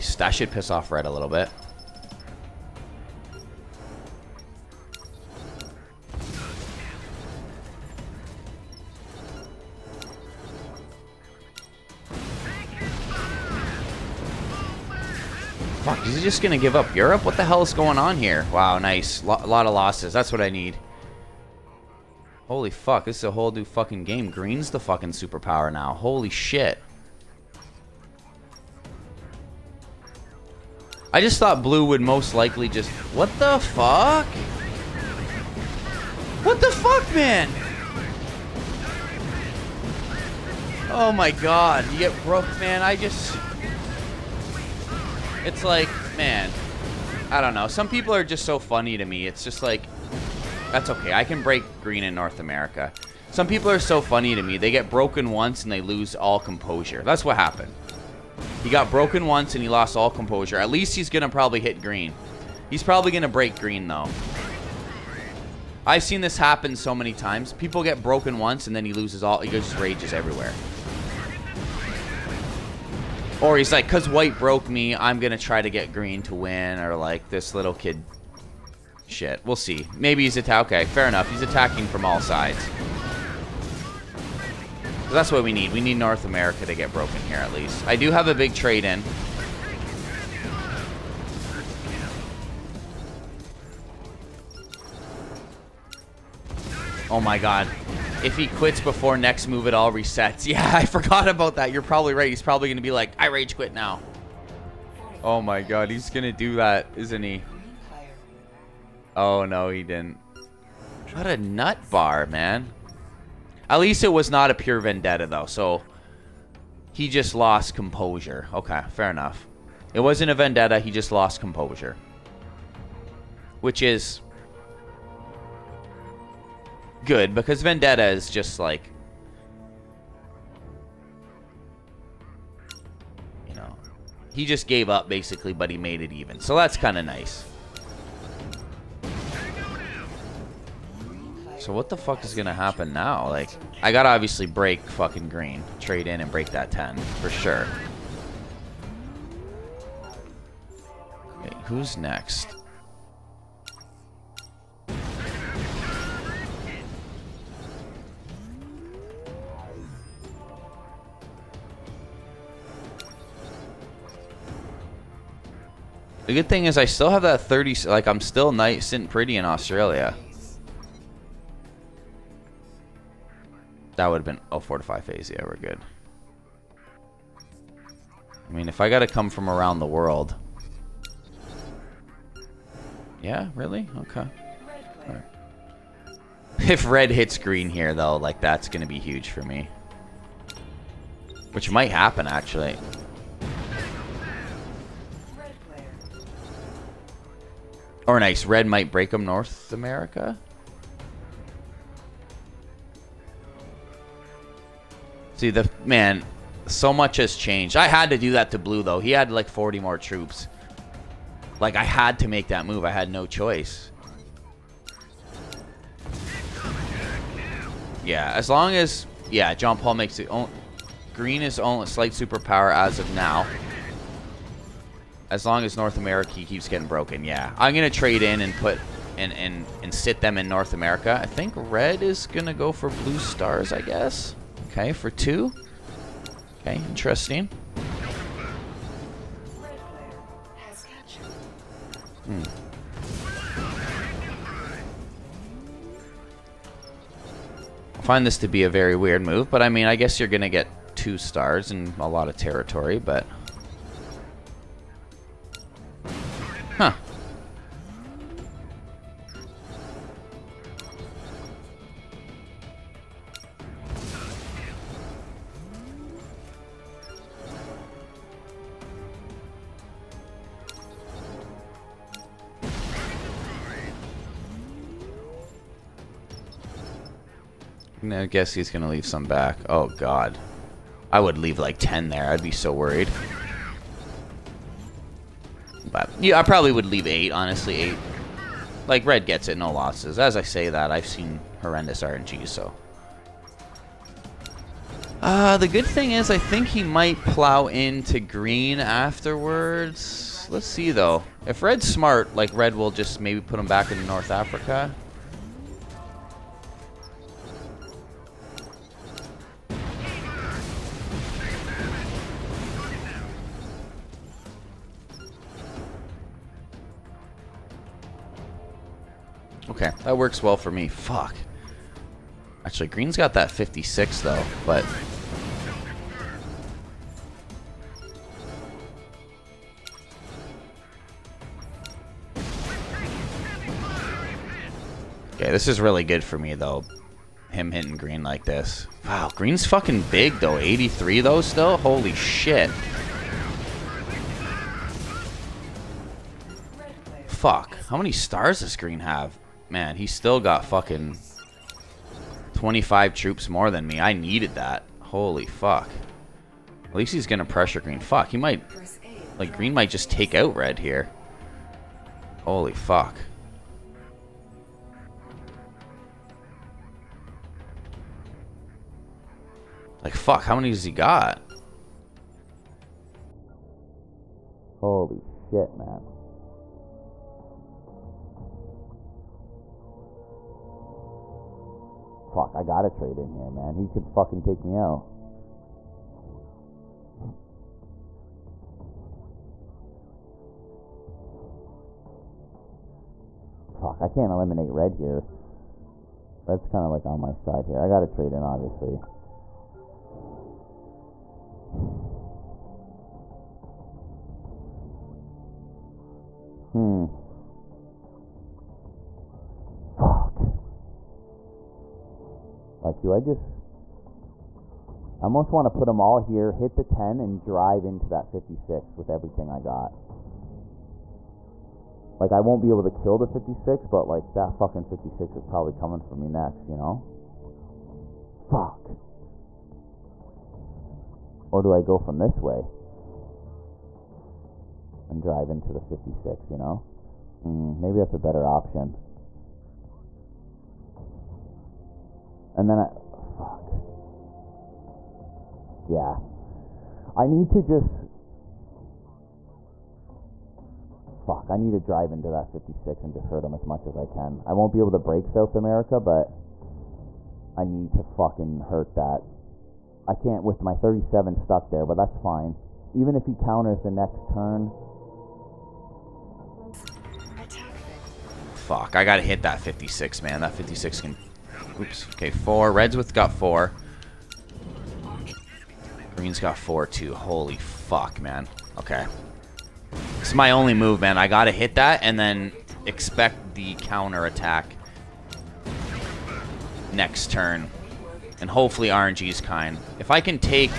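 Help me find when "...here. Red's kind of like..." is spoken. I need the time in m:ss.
6:34.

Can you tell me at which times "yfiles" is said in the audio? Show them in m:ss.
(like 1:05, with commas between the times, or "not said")
not said.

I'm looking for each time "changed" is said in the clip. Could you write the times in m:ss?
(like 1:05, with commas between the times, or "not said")
3:27.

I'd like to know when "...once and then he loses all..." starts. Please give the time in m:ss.
1:08.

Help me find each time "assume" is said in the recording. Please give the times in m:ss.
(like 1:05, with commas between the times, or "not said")
not said.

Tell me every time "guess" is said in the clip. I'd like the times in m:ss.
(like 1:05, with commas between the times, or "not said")
3:53, 4:09, 4:38.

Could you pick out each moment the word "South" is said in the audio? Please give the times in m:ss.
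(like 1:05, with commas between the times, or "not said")
7:35.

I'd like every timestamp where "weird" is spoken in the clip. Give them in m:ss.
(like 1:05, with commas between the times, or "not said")
4:08.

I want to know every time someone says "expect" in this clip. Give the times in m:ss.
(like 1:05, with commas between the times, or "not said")
8:02.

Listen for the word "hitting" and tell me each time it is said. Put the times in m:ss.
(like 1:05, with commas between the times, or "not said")
5:37.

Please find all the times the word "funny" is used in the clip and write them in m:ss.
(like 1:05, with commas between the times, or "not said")
0:48, 0:54.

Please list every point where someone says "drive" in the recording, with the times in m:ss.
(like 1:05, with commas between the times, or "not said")
6:57, 7:15, 7:31.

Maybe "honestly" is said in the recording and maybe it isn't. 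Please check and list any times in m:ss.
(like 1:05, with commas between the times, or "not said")
4:47.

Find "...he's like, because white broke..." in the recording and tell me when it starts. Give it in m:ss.
1:13.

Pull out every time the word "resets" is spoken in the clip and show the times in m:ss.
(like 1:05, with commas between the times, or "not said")
1:39.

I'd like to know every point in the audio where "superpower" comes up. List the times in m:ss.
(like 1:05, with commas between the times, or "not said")
0:25, 3:42.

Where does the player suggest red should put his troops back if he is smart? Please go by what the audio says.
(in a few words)
North Africa.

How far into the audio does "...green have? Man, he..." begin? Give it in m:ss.
5:48.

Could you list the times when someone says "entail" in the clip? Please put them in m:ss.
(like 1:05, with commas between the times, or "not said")
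not said.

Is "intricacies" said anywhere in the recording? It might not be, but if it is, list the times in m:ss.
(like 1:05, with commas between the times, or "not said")
not said.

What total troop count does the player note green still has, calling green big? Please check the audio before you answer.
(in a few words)
83.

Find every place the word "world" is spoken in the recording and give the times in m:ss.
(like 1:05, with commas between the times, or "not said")
2:59.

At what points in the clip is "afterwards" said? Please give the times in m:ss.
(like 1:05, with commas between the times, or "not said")
4:58.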